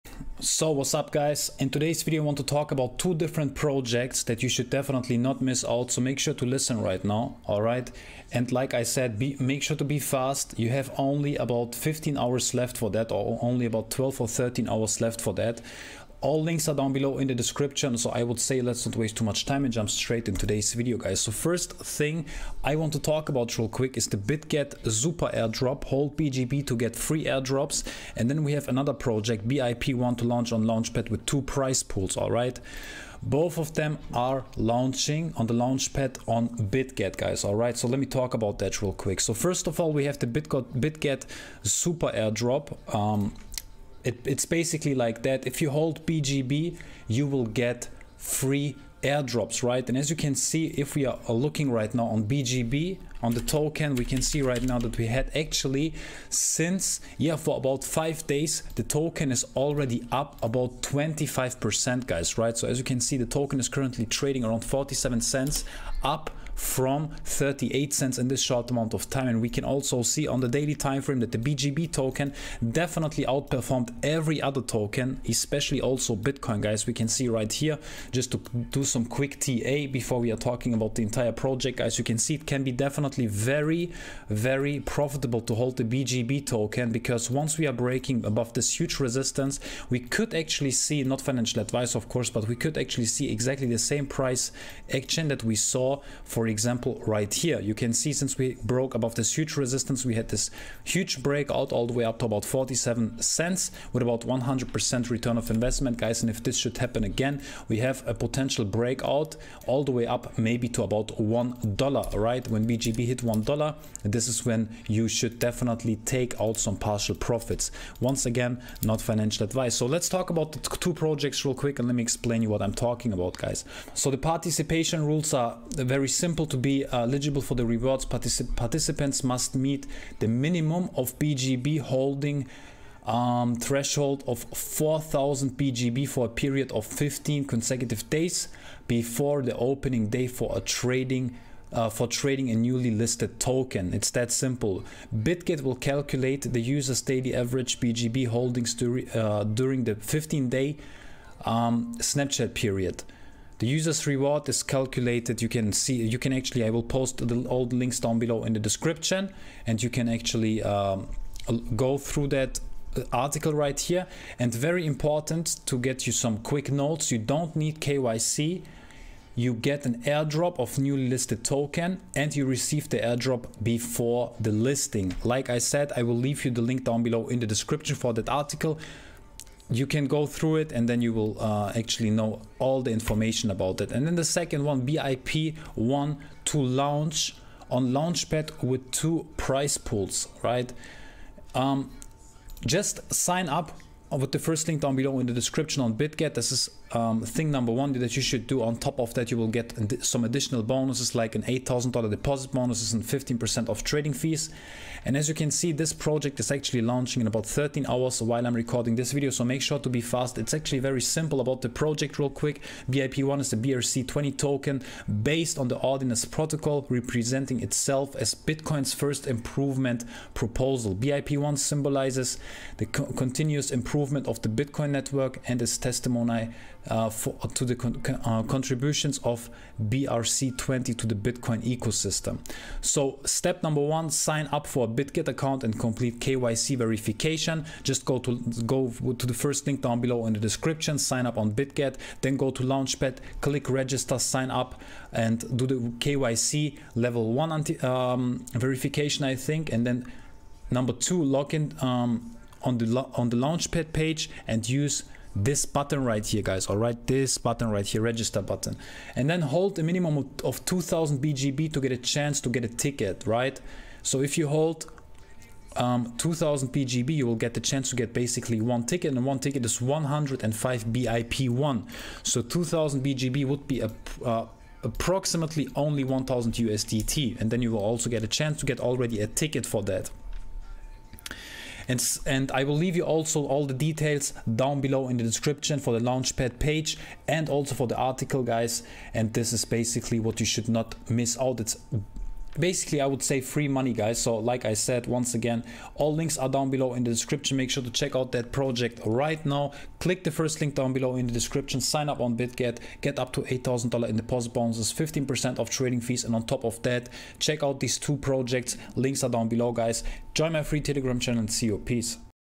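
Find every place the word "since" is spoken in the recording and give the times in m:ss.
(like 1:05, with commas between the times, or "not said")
0:56, 1:38.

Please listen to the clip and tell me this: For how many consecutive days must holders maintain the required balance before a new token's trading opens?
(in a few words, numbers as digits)
15.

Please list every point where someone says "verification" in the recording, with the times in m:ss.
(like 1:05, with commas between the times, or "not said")
3:56, 4:08.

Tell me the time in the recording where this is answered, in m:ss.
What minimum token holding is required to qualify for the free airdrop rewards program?
2:14.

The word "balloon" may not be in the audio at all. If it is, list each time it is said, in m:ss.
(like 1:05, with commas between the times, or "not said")
not said.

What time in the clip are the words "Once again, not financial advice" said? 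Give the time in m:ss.
1:57.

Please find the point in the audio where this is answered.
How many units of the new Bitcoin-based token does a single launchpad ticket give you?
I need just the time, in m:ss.
4:29.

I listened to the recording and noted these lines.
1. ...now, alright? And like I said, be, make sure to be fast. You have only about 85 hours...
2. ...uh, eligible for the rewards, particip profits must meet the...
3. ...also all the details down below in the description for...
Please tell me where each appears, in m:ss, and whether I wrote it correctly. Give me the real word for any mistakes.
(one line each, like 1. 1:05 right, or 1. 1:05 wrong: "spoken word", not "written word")
1. 0:07 wrong: "15", not "85"
2. 2:06 wrong: "participants", not "profits"
3. 4:43 right.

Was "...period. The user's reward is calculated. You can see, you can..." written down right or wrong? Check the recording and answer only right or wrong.
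right.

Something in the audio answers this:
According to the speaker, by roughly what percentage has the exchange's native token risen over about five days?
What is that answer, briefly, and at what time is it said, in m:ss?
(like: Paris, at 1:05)
25%, at 1:00.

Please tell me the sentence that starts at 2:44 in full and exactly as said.
And very important to get you some quick notes.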